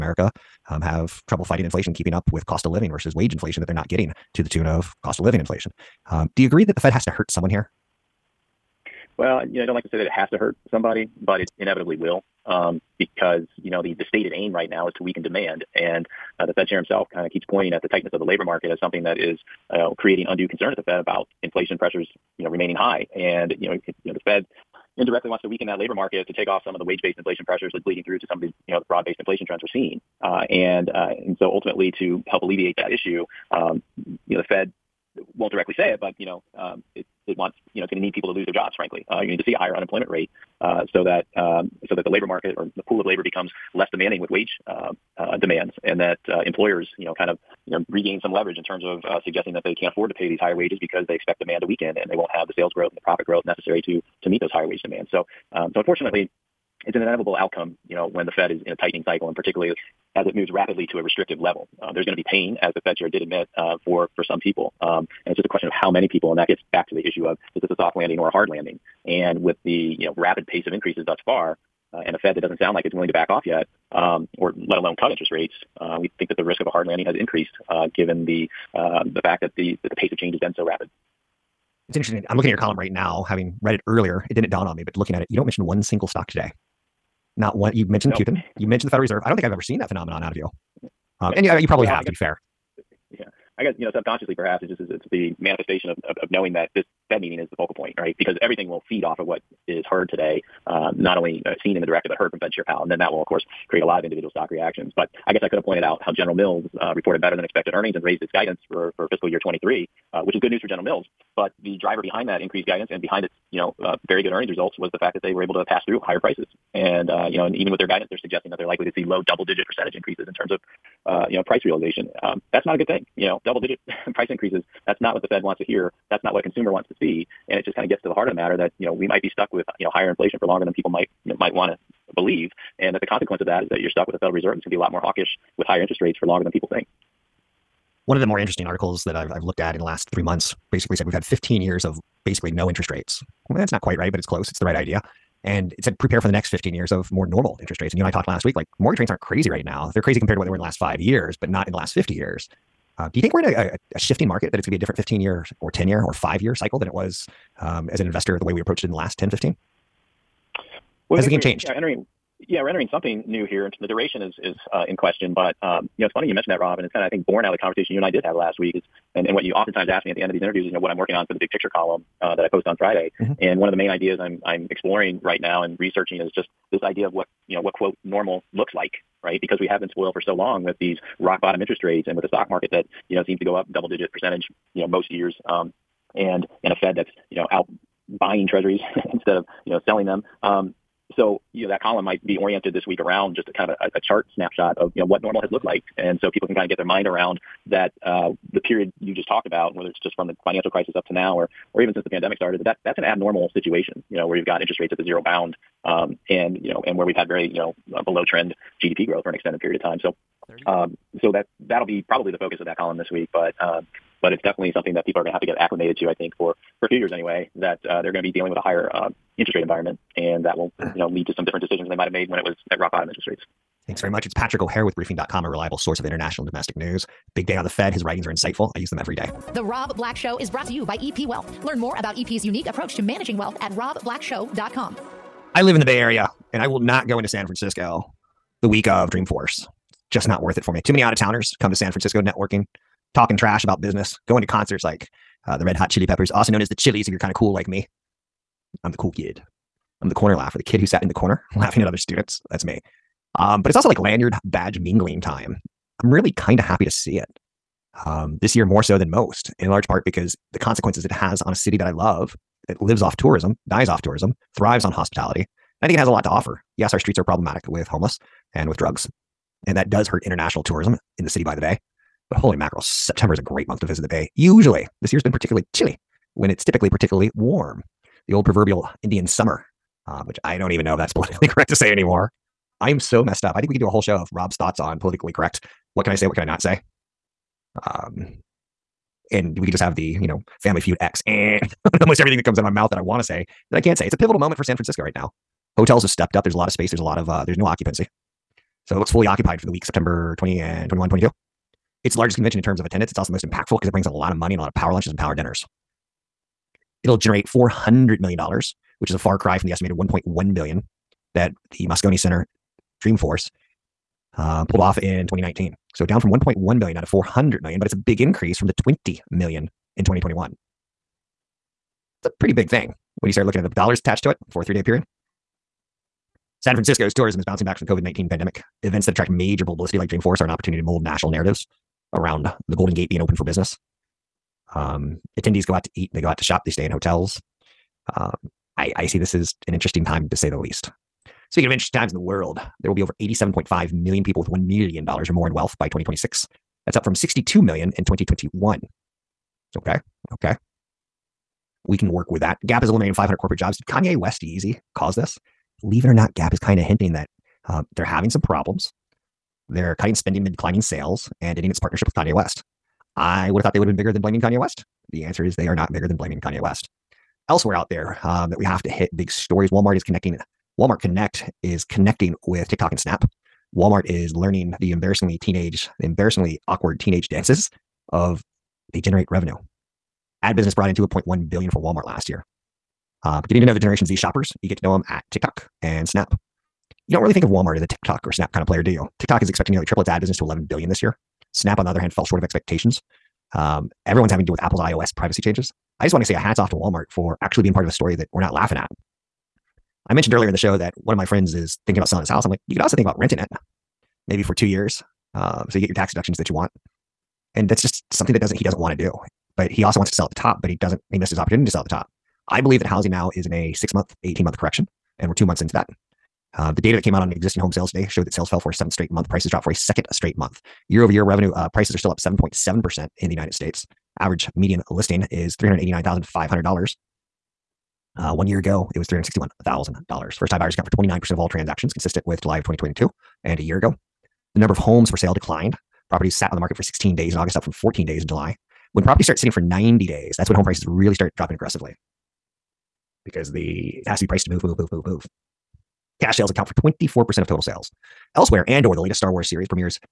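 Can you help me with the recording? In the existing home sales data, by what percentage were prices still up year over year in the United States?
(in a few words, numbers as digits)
7.7%.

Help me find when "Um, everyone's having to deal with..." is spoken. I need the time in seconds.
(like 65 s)
393 s.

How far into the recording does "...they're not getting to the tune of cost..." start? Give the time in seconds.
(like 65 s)
3 s.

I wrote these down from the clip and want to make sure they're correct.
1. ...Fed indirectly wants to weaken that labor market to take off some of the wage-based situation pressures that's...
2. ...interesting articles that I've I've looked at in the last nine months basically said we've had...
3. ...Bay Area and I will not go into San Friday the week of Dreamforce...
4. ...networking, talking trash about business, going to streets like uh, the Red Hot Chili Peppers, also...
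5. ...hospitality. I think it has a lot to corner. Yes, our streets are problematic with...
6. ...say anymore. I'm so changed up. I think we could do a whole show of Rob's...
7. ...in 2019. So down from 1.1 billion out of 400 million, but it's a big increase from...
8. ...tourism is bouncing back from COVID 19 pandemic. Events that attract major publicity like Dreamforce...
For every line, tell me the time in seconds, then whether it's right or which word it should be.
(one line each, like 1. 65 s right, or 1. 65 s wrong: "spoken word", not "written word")
1. 24 s wrong: "inflation", not "situation"
2. 138 s wrong: "three", not "nine"
3. 235 s wrong: "Francisco", not "Friday"
4. 242 s wrong: "concerts", not "streets"
5. 264 s wrong: "offer", not "corner"
6. 281 s wrong: "messed", not "changed"
7. 314 s right
8. 327 s right.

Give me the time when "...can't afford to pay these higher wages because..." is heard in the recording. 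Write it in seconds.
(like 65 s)
49 s.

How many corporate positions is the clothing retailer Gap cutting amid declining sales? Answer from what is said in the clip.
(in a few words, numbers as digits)
500.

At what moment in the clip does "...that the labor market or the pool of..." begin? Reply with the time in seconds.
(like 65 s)
41 s.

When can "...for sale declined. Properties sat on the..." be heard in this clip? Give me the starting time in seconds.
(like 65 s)
435 s.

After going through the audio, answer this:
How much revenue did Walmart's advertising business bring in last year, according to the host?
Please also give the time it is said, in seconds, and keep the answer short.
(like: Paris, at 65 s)
2.1 billion, at 380 s.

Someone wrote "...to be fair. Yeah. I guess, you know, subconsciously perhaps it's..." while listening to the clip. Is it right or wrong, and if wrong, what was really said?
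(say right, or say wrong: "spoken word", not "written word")
right.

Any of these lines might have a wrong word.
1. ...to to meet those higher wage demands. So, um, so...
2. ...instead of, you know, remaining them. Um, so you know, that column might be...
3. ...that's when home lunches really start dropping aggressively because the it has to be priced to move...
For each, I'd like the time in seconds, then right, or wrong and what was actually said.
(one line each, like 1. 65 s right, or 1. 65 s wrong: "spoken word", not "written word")
1. 53 s right
2. 189 s wrong: "selling", not "remaining"
3. 440 s wrong: "prices", not "lunches".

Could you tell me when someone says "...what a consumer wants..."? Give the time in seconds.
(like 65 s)
126 s.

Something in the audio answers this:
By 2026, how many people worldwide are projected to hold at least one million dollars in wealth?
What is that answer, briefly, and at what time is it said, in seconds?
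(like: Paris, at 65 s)
87.5 million, at 343 s.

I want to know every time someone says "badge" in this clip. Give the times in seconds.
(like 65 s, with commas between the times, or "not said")
254 s.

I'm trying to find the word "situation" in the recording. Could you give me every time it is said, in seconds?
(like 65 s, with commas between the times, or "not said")
203 s.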